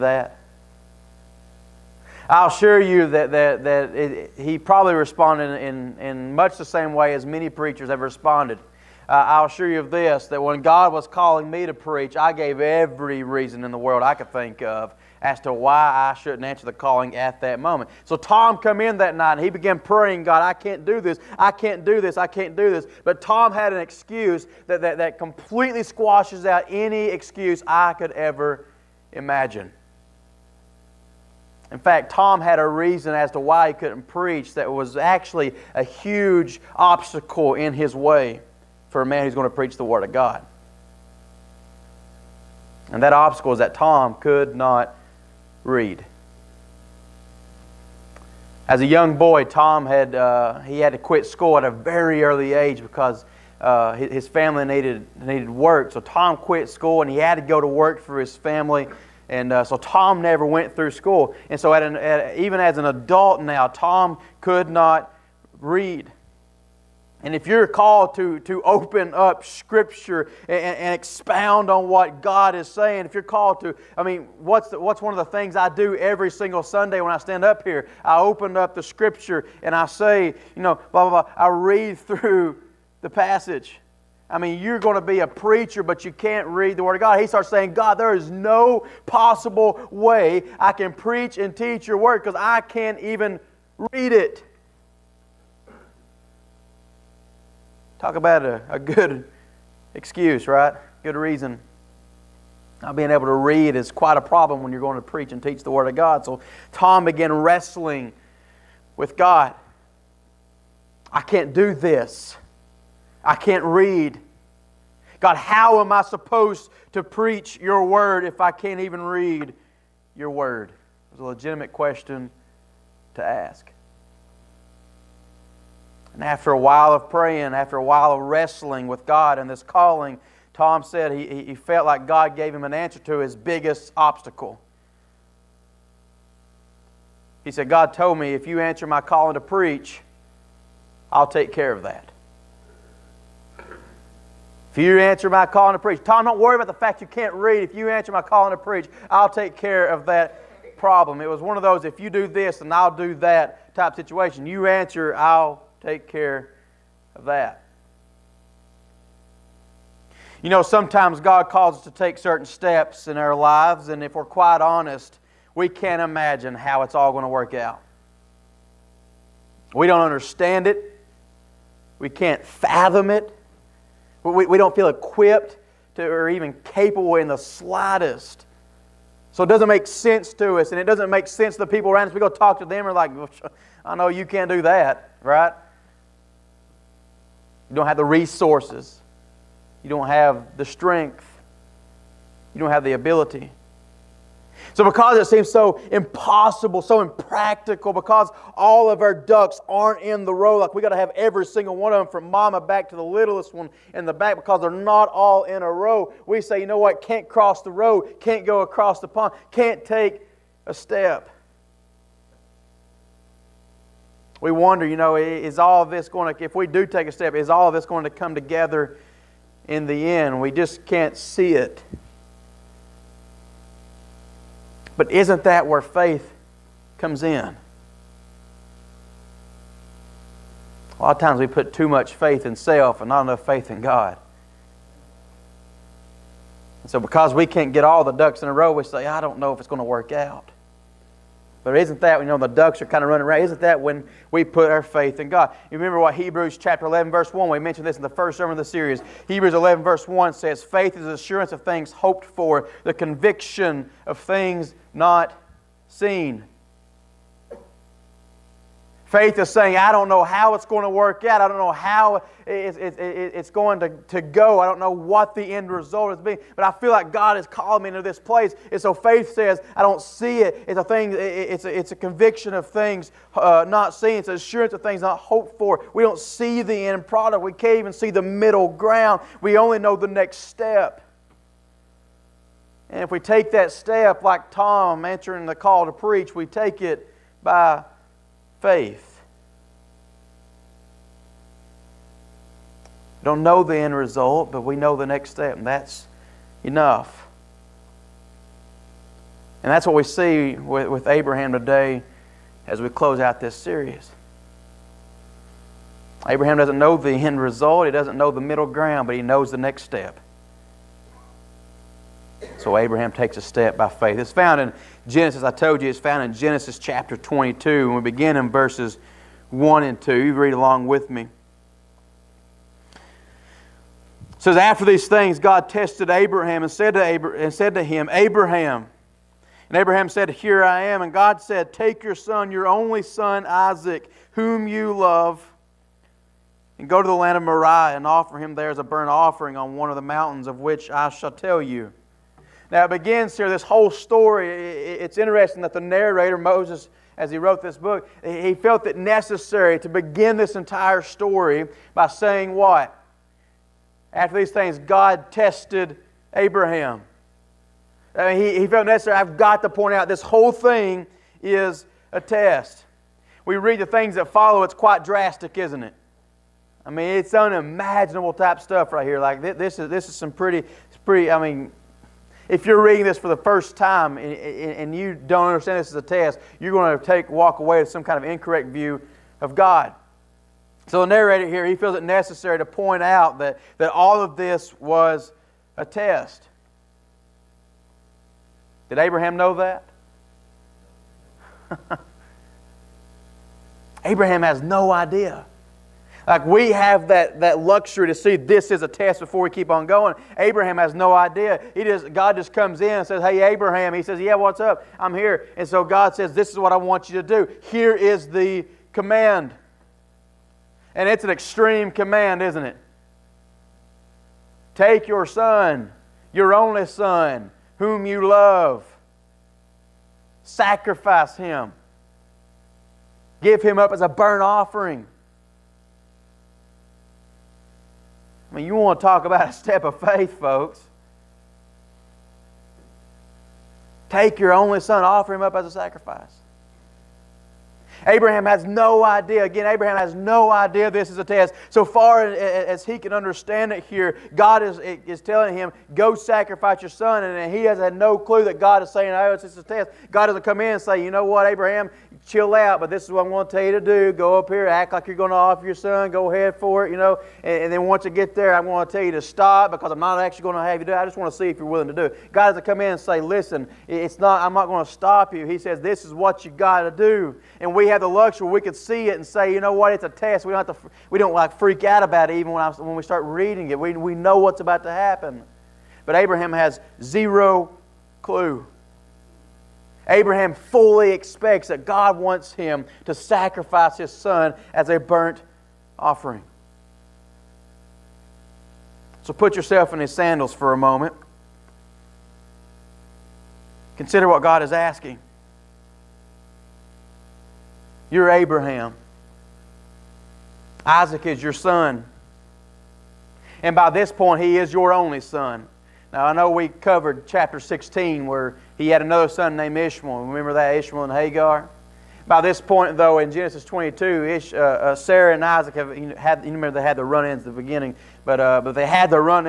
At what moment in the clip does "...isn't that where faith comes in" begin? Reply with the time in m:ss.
3:45.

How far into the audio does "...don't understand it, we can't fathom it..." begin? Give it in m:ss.
2:49.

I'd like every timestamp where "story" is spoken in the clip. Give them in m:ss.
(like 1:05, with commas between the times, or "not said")
5:43, 5:51.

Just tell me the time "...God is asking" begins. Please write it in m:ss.
8:14.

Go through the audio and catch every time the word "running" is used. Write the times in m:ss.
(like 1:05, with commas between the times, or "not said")
4:03.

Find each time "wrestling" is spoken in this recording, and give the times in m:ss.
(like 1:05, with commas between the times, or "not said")
1:47, 2:08.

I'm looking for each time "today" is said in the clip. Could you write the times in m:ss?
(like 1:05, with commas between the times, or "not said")
5:01.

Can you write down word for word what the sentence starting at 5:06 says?
Abraham doesn't know the end result, he doesn't know the middle ground, but he knows the next step.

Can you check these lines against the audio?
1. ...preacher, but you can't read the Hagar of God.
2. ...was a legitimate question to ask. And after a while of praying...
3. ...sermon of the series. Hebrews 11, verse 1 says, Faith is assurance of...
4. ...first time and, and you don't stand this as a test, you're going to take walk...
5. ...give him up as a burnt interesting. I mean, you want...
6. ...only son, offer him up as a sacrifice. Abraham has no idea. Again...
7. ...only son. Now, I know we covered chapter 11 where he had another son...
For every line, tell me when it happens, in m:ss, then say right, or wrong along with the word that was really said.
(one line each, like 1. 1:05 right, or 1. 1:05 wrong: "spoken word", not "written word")
1. 1:25 wrong: "Word", not "Hagar"
2. 2:01 right
3. 4:08 right
4. 6:13 wrong: "understand", not "stand"
5. 7:03 wrong: "offering", not "interesting"
6. 7:14 right
7. 8:24 wrong: "16", not "11".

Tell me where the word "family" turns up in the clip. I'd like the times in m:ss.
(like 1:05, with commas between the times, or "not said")
0:54, 0:58.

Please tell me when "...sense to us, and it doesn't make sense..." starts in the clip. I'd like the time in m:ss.
2:59.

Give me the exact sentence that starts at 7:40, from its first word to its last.
I just want to see if you're willing to do it.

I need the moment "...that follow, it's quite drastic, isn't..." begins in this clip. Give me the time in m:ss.
6:04.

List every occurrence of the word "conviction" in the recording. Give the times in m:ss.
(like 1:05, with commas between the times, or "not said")
4:12, 4:31.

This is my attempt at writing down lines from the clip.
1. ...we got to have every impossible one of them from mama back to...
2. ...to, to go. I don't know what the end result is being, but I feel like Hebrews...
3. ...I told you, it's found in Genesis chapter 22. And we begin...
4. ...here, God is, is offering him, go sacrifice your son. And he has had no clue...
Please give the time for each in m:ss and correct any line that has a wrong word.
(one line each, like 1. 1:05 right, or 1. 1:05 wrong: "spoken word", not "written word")
1. 3:20 wrong: "single", not "impossible"
2. 4:23 wrong: "God", not "Hebrews"
3. 5:15 right
4. 7:23 wrong: "telling", not "offering".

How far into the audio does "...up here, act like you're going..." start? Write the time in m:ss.
7:34.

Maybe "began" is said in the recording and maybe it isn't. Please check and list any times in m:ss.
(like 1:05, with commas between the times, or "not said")
0:19, 1:47.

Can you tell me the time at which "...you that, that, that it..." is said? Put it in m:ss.
0:02.